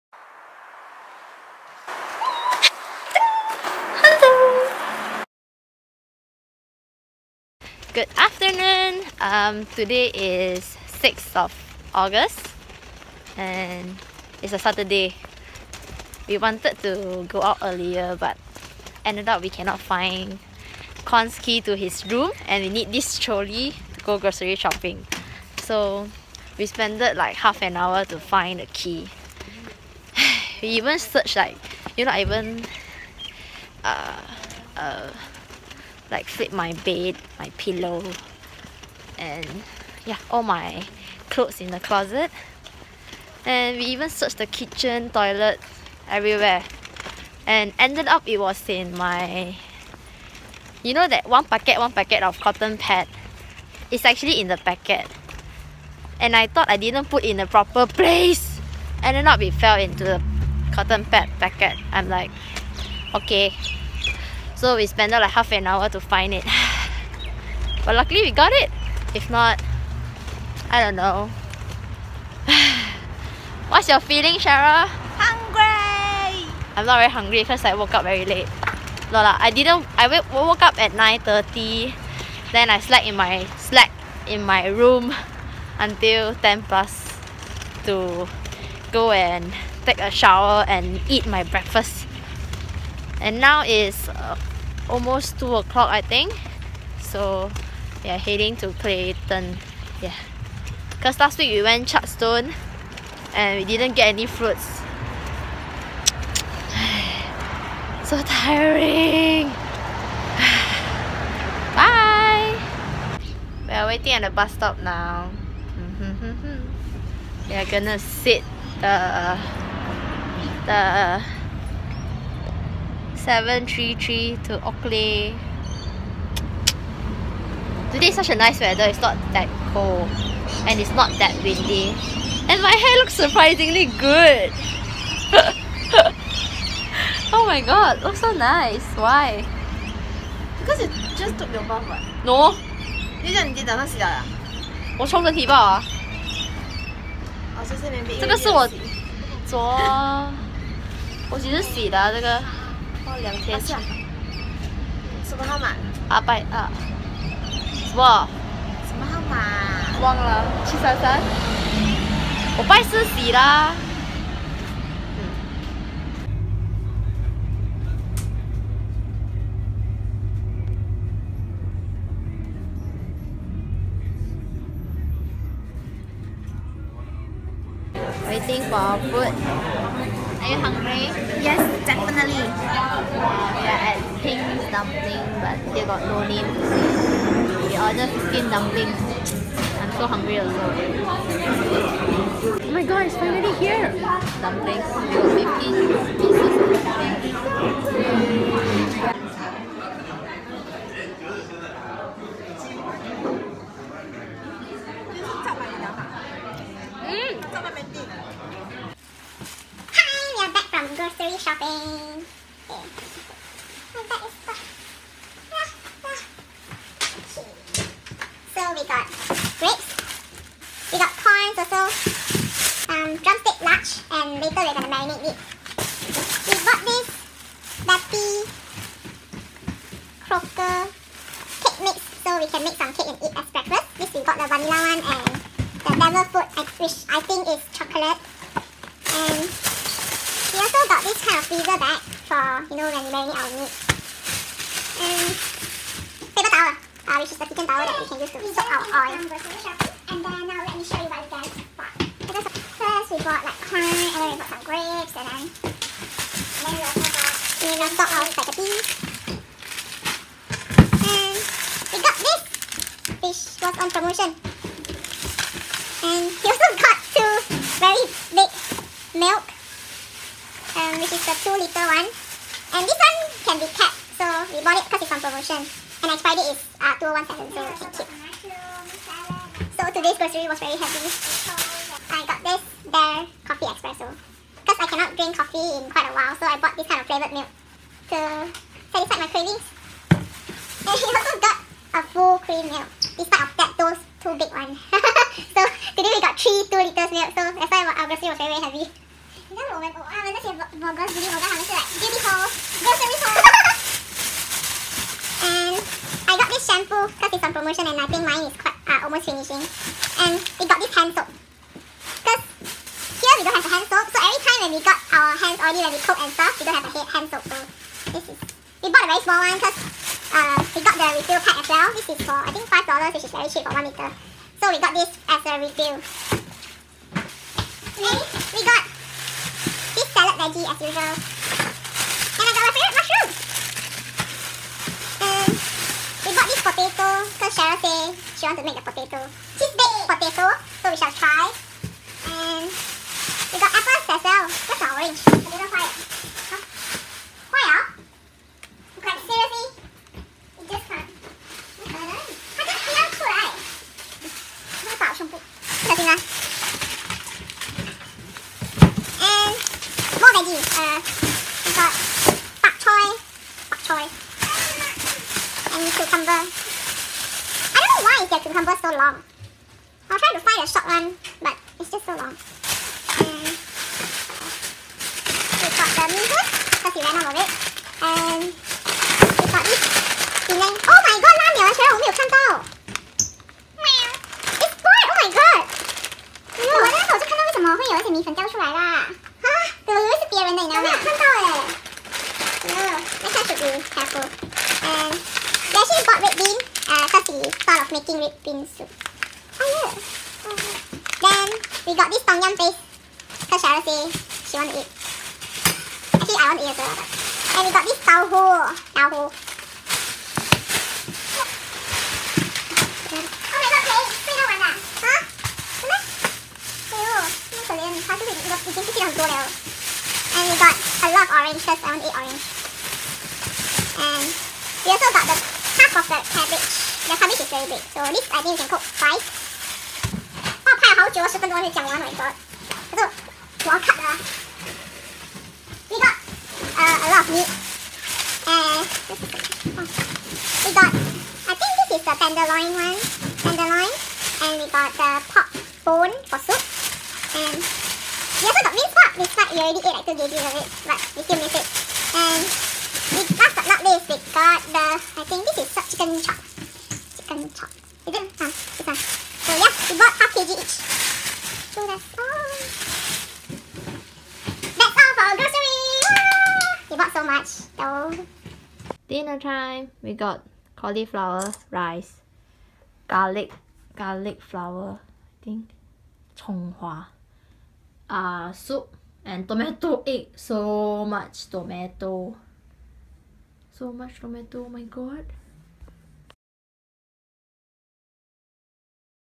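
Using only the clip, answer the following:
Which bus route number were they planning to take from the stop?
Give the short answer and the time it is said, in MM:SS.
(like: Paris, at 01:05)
733, at 02:03.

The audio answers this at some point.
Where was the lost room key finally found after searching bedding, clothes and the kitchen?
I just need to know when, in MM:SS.
01:00.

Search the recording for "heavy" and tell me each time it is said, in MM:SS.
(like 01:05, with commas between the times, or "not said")
04:40, 04:58.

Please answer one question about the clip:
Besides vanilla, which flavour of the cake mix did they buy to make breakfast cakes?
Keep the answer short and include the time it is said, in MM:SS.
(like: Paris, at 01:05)
devil food, at 03:55.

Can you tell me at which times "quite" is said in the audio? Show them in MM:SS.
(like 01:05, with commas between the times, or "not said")
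04:45, 05:08.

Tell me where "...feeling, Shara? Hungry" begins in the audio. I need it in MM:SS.
01:13.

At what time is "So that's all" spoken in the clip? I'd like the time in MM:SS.
07:41.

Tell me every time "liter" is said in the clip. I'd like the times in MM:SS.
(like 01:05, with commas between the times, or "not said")
04:31, 04:56, 05:23.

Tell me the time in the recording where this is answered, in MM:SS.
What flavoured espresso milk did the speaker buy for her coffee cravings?
04:42.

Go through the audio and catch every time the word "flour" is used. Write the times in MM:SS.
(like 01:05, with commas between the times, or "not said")
07:54.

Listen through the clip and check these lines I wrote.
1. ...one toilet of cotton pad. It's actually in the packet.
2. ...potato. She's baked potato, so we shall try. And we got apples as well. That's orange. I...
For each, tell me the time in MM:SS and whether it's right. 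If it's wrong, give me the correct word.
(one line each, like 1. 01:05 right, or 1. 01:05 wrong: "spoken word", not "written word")
1. 00:51 wrong: "packet", not "toilet"
2. 05:38 right.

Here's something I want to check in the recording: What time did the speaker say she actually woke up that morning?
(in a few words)
9:30.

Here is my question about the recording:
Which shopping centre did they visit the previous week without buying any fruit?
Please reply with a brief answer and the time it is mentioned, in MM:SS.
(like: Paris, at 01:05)
Chadstone, at 01:41.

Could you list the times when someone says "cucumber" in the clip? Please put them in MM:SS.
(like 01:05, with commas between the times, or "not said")
06:08.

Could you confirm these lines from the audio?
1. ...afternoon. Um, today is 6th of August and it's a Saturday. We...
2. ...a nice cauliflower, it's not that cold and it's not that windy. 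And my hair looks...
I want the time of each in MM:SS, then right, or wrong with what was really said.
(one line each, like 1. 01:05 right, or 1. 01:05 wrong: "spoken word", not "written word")
1. 00:08 right
2. 02:08 wrong: "weather", not "cauliflower".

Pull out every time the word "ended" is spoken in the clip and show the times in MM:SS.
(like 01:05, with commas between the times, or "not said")
00:19, 00:47, 00:59.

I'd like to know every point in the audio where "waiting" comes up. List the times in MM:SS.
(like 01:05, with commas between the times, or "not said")
01:53, 02:58.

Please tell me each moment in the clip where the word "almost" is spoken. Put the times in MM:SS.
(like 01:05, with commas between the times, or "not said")
01:34, 05:09.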